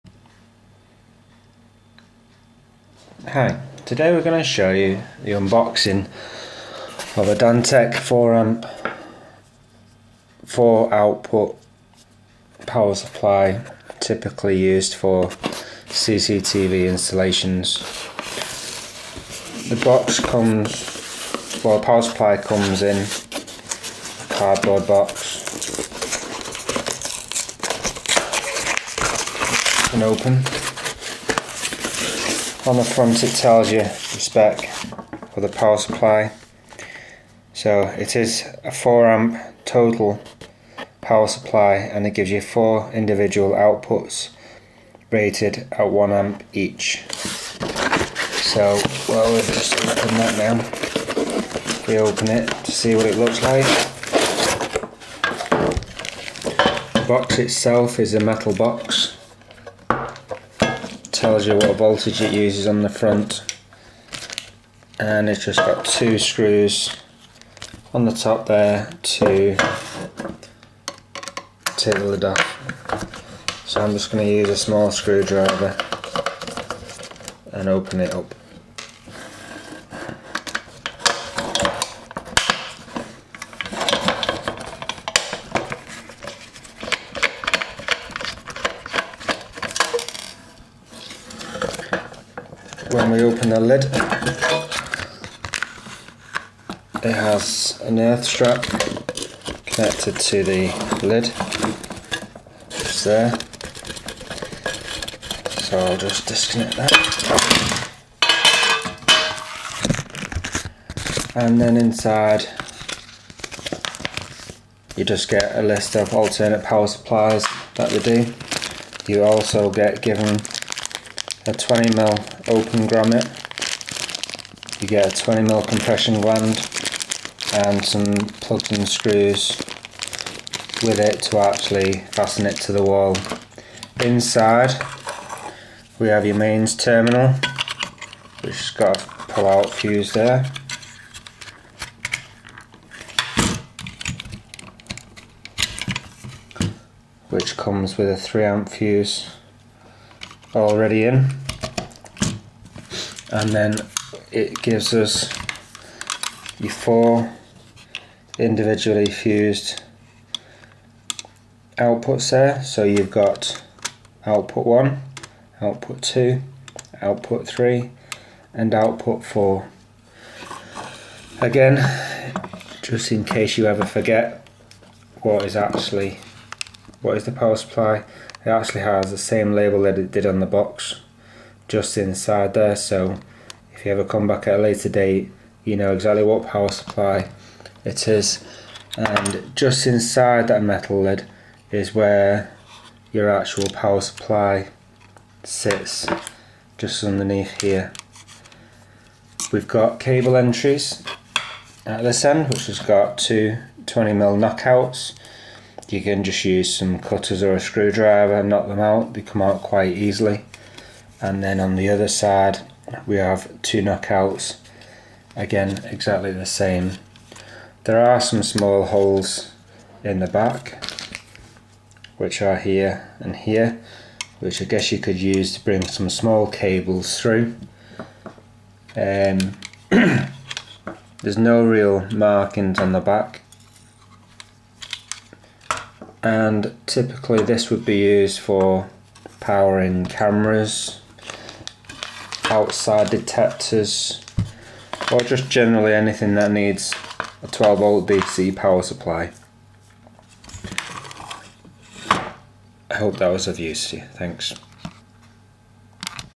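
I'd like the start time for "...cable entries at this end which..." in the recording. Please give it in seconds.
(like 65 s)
199 s.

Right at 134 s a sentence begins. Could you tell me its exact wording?
Inside we have your mains terminal which has got a pull out fuse there.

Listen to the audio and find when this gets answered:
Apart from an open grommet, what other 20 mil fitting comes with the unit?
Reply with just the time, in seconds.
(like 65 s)
125 s.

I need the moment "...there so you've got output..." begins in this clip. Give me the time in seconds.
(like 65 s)
162 s.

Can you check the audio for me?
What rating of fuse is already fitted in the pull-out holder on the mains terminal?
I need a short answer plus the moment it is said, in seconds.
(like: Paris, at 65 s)
3 amp, at 148 s.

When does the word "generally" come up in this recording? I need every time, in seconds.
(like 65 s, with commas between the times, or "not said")
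245 s.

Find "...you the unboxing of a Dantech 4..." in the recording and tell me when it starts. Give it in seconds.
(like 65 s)
4 s.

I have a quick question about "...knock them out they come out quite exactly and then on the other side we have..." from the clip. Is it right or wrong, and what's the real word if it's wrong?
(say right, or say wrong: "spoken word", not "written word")
wrong: "easily", not "exactly".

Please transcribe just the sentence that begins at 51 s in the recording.
we open it to see what it looks like.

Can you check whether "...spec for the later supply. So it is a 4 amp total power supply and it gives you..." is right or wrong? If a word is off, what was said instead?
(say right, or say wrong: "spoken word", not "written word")
wrong: "power", not "later".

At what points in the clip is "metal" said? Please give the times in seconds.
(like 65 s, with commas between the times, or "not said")
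58 s, 190 s.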